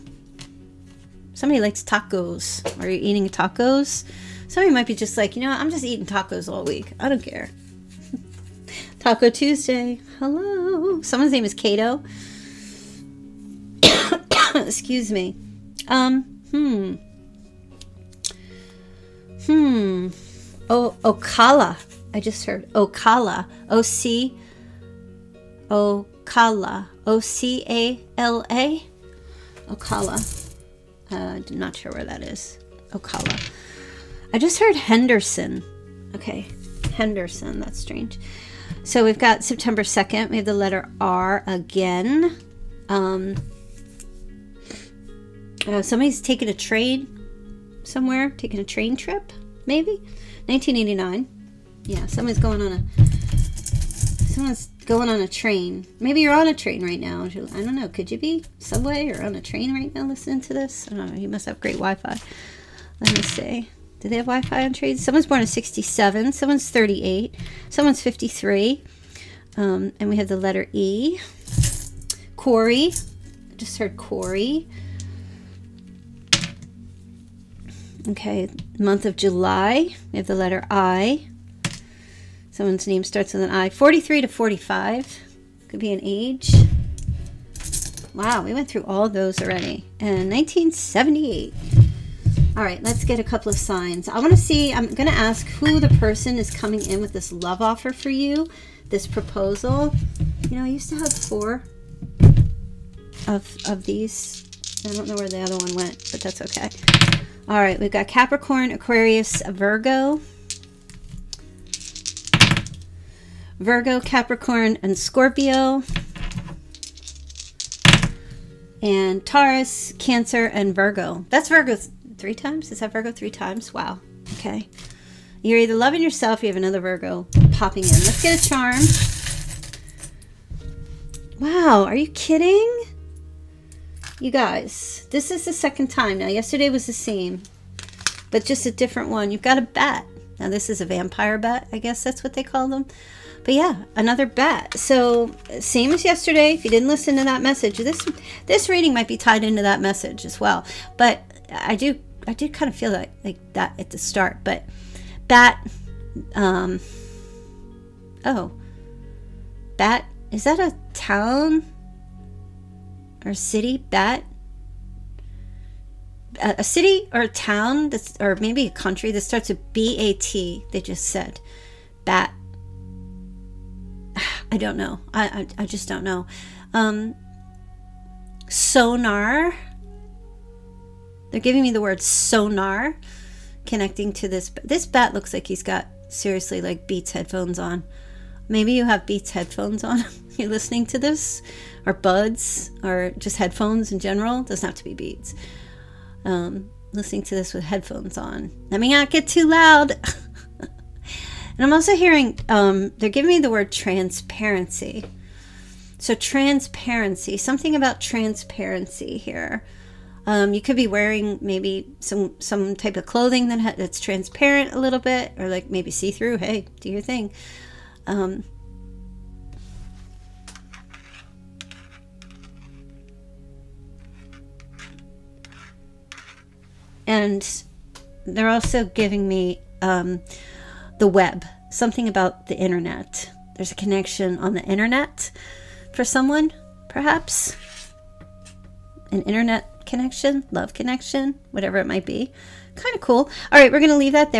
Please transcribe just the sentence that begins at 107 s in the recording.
All right, we've got Capricorn, Aquarius, Virgo.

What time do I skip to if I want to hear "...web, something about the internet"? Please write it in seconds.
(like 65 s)
231 s.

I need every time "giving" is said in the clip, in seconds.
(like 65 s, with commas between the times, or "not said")
181 s, 203 s, 228 s.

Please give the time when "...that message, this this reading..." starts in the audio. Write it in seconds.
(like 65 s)
147 s.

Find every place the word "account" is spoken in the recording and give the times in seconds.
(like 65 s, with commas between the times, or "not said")
not said.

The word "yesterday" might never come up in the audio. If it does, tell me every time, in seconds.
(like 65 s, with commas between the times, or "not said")
136 s, 146 s.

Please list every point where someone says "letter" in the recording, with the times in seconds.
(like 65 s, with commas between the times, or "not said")
40 s, 70 s, 80 s.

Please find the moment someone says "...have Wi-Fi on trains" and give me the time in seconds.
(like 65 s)
64 s.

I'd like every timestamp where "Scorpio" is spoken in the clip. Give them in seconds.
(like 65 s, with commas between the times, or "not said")
114 s.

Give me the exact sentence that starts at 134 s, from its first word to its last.
You guys, this is the second time now.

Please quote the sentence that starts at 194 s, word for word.
It doesn't have to be Beats.